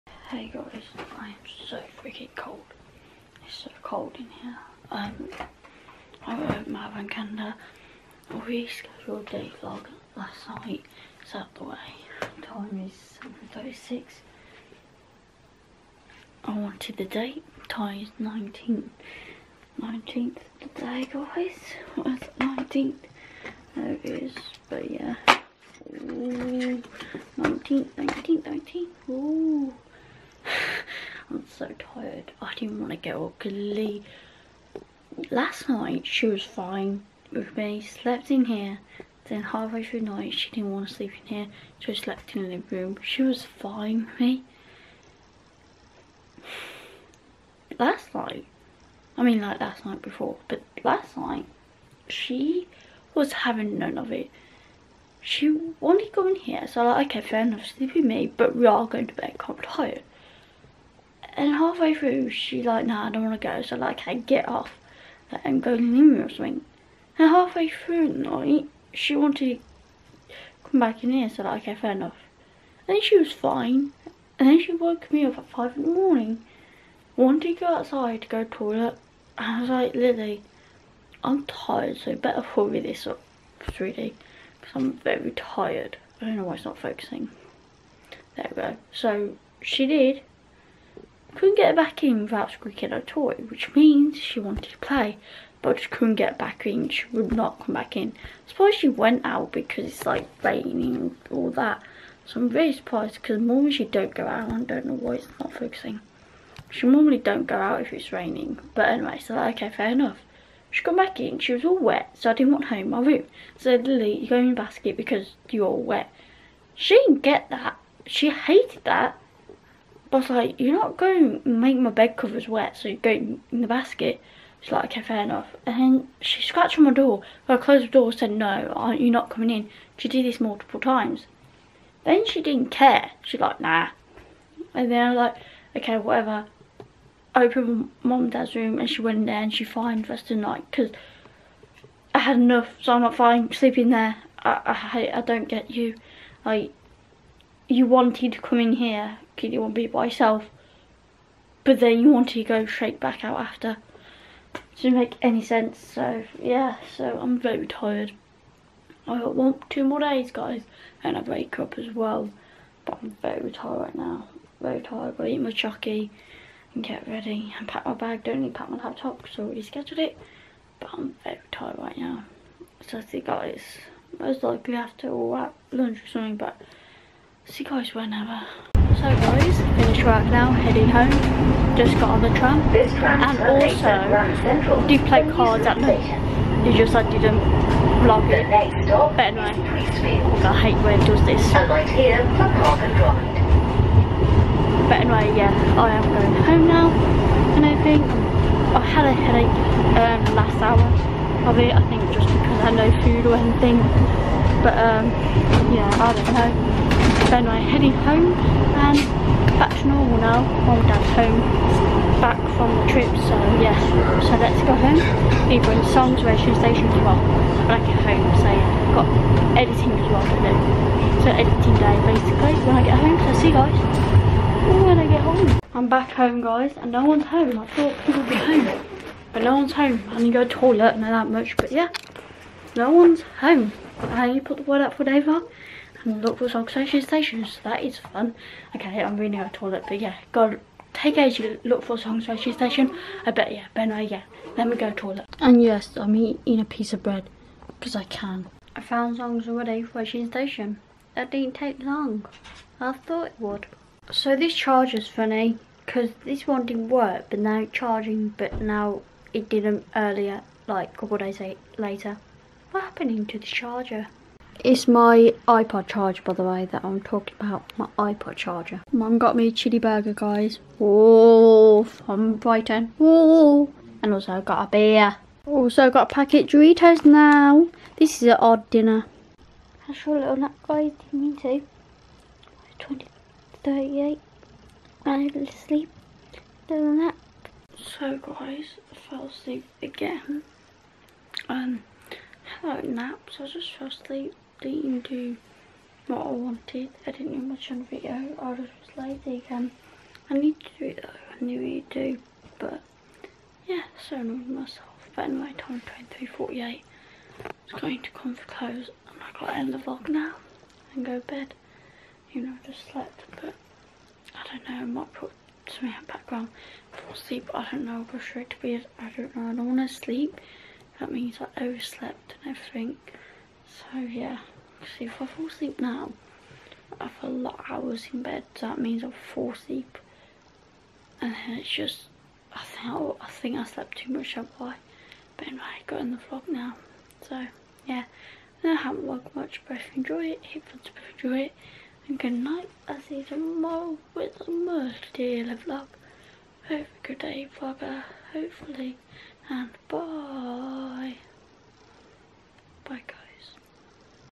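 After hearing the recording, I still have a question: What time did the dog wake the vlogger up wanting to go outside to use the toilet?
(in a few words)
5 in the morning.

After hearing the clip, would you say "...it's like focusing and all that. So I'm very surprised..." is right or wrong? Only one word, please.
wrong.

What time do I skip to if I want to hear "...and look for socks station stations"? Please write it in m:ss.
3:56.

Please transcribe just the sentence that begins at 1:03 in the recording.
So like, I get off like, and go to the or something.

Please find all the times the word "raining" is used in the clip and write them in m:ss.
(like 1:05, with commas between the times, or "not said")
1:40, 1:48.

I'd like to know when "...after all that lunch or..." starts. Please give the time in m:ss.
2:54.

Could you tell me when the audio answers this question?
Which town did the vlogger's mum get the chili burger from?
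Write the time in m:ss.
4:32.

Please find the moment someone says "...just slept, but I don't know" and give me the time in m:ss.
5:12.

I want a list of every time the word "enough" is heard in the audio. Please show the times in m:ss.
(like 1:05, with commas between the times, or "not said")
0:57, 1:11, 1:49, 2:05, 2:22.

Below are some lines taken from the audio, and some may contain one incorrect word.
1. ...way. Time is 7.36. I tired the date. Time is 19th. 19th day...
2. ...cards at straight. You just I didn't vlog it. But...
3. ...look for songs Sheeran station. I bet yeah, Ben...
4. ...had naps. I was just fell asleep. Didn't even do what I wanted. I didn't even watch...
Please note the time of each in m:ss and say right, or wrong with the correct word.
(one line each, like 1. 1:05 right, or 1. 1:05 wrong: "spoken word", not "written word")
1. 0:11 wrong: "wanted", not "tired"
2. 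3:05 wrong: "night", not "straight"
3. 4:01 right
4. 4:52 right.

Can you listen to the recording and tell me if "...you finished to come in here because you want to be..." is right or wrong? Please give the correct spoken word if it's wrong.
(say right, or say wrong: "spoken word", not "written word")
wrong: "wanted", not "finished".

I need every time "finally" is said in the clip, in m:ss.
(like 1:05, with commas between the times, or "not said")
not said.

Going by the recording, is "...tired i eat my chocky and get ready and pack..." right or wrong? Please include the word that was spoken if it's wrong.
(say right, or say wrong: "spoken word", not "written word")
right.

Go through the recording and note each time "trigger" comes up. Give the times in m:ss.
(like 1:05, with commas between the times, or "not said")
not said.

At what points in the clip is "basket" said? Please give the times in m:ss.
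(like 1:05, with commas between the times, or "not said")
1:54, 2:03.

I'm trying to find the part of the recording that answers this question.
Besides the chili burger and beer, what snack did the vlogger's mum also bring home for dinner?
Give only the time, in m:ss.
4:36.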